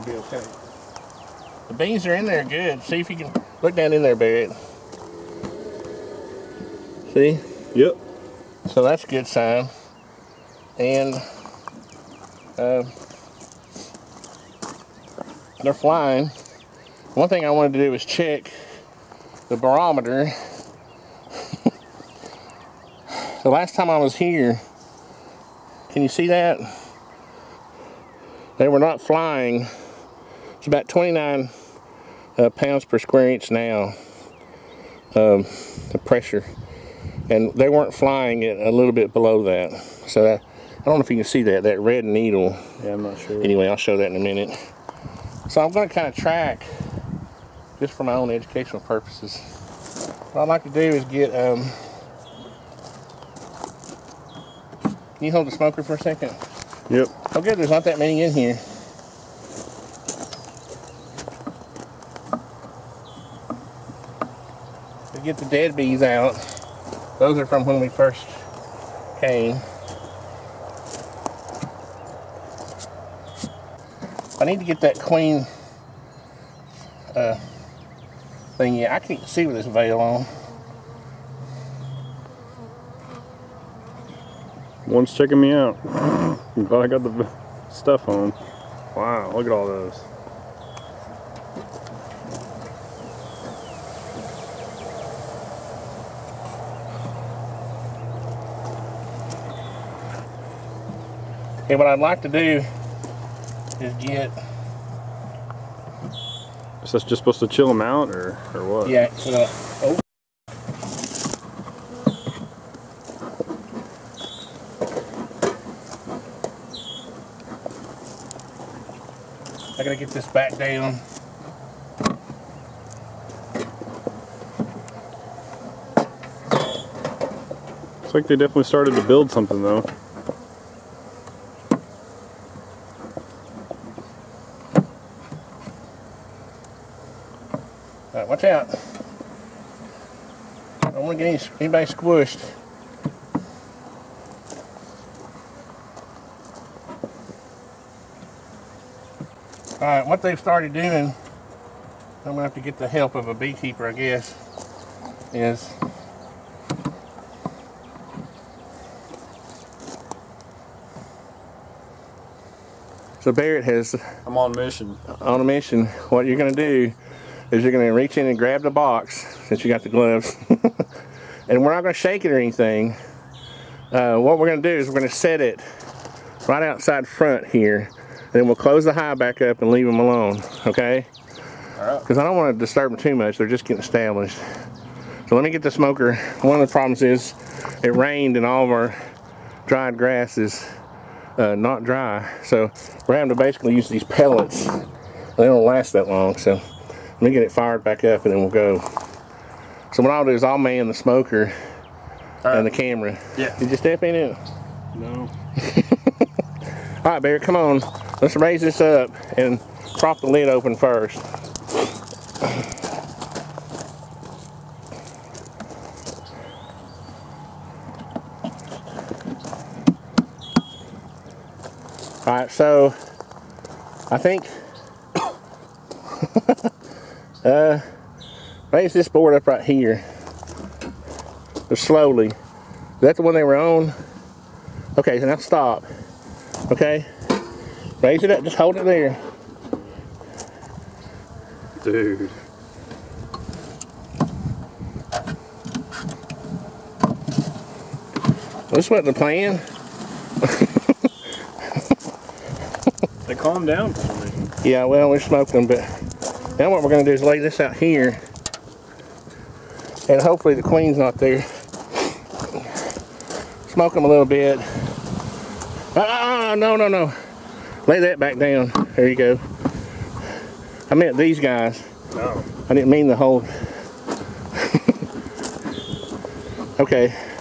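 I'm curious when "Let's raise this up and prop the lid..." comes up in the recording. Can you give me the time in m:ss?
3:28.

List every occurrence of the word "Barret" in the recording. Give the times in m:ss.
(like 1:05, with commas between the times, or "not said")
0:04, 2:43.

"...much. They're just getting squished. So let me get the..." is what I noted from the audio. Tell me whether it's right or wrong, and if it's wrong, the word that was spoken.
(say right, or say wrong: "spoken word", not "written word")
wrong: "established", not "squished".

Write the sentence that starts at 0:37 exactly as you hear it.
And they weren't flying it a little bit below that.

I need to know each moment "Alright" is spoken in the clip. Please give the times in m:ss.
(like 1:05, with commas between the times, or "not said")
2:29.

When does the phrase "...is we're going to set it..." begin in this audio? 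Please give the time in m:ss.
2:54.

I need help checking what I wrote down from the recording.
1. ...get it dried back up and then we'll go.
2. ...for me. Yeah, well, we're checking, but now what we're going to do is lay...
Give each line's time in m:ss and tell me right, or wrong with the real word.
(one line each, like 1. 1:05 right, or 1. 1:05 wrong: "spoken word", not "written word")
1. 3:17 wrong: "fired", not "dried"
2. 4:13 wrong: "smoking", not "checking".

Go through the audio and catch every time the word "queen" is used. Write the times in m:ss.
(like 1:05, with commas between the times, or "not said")
1:14, 4:20.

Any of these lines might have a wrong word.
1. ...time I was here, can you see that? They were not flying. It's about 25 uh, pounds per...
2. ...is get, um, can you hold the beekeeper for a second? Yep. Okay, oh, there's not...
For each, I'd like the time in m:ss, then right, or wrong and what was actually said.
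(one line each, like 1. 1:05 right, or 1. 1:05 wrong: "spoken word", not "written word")
1. 0:23 wrong: "29", not "25"
2. 0:50 wrong: "smoker", not "beekeeper".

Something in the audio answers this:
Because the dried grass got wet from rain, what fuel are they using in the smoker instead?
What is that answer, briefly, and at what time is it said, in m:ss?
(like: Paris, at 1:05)
pellets, at 3:14.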